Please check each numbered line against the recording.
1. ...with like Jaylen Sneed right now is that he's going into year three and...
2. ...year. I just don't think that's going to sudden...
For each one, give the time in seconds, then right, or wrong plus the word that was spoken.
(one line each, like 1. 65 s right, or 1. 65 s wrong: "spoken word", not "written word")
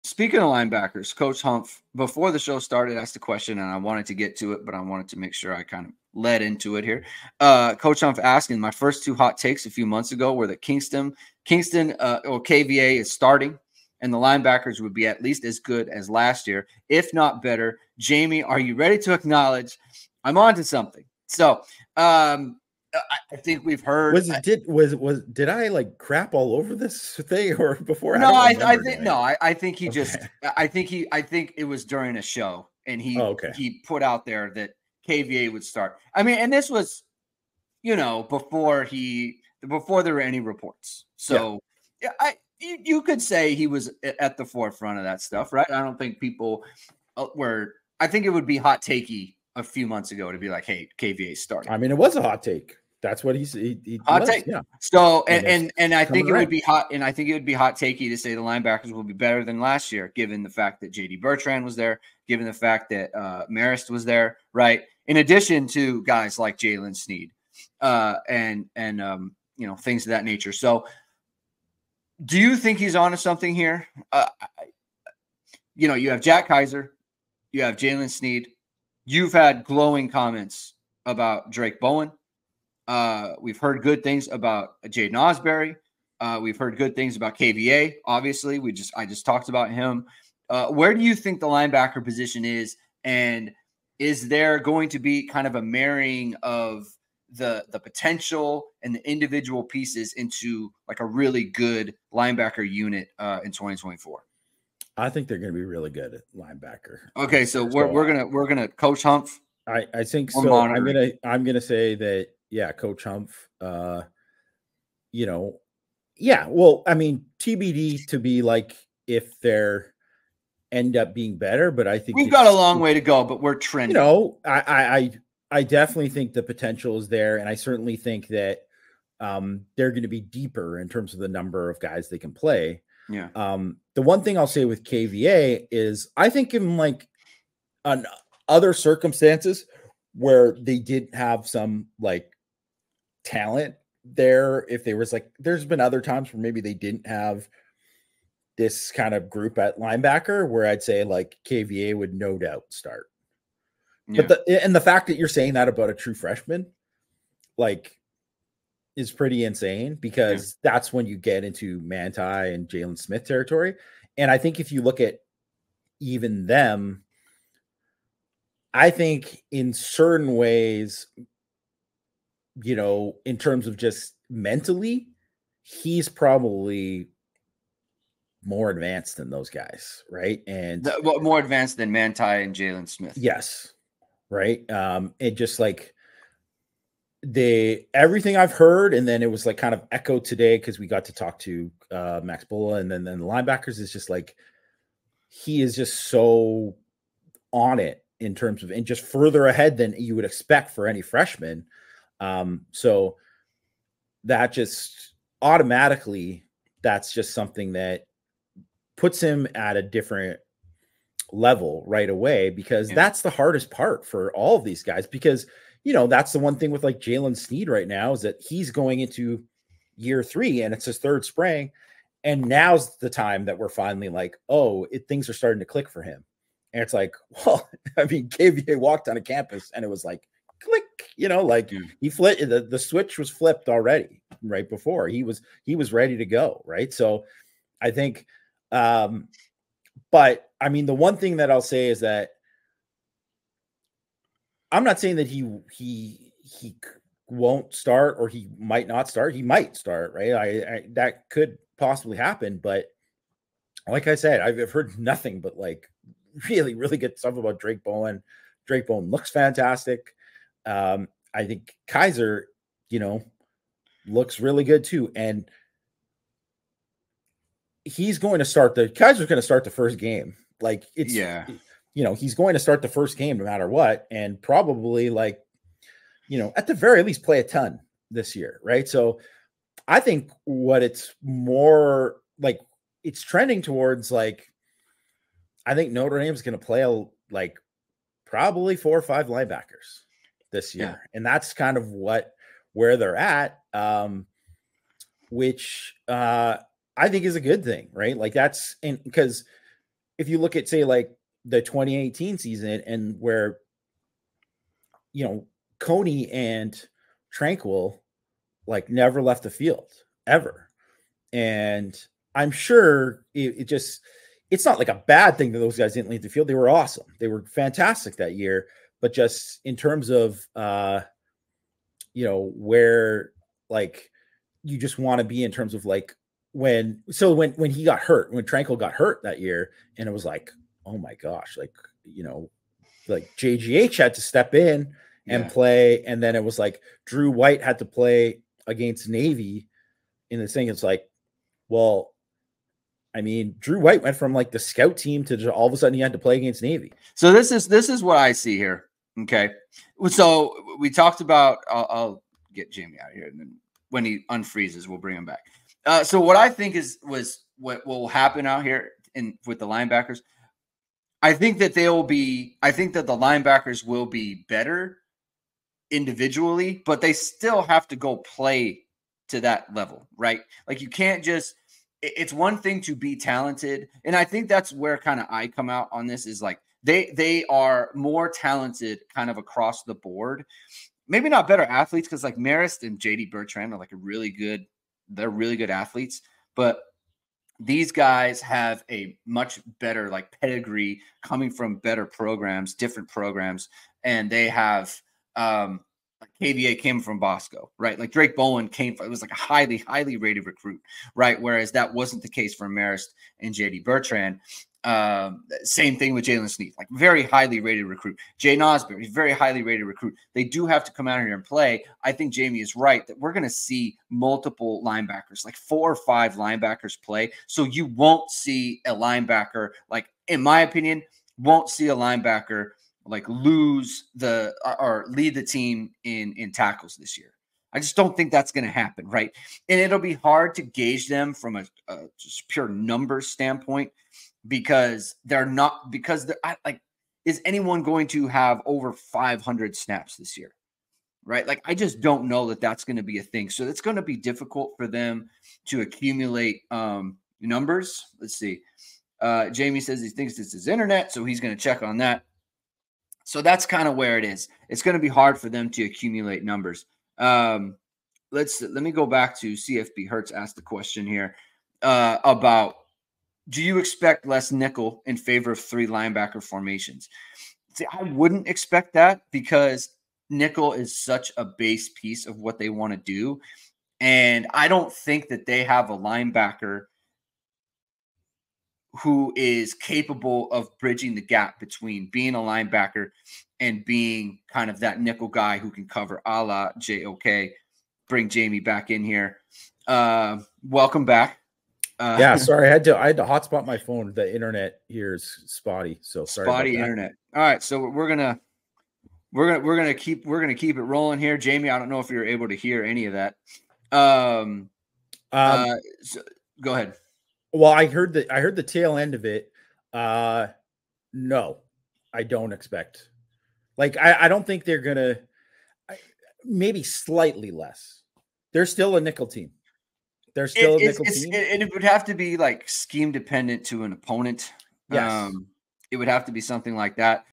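1. 216 s right
2. 427 s wrong: "happen", not "sudden".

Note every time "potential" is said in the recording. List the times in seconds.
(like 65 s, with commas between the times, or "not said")
97 s, 126 s.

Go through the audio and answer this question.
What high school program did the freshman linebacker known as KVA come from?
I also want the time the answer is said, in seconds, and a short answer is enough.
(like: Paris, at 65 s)
Bosco, at 397 s.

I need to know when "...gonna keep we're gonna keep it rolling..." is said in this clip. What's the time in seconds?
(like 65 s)
499 s.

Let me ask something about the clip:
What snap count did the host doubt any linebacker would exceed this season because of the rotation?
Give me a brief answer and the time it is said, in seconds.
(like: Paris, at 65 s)
500, at 438 s.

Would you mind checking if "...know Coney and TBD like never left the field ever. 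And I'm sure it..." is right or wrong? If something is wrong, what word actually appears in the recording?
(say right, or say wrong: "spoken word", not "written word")
wrong: "Tranquill", not "TBD".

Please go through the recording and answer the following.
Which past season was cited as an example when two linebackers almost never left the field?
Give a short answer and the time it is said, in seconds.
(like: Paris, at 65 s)
2018, at 301 s.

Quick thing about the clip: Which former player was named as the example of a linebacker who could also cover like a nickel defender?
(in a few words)
JOK.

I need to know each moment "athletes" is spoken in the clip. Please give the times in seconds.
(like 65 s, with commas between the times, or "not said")
381 s, 385 s.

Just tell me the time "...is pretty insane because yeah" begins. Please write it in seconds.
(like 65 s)
158 s.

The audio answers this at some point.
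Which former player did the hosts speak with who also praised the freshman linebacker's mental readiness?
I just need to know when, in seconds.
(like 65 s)
192 s.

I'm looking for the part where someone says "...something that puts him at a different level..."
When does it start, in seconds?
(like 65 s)
207 s.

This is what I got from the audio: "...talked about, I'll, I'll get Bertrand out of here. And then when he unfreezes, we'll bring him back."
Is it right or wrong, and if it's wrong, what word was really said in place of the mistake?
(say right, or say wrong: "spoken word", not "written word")
wrong: "Jamie", not "Bertrand".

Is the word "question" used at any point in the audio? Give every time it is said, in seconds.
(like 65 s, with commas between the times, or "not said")
3 s, 460 s.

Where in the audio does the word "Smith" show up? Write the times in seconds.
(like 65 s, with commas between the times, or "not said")
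162 s, 182 s.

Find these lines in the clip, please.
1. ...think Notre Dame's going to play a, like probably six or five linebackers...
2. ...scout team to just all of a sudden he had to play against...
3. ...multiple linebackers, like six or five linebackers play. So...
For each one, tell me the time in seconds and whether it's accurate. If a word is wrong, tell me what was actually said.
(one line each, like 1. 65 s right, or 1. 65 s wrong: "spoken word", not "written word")
1. 285 s wrong: "four", not "six"
2. 344 s right
3. 414 s wrong: "four", not "six".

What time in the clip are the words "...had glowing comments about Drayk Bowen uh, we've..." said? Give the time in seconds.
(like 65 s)
79 s.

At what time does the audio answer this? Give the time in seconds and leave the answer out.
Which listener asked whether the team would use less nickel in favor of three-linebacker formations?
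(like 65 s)
459 s.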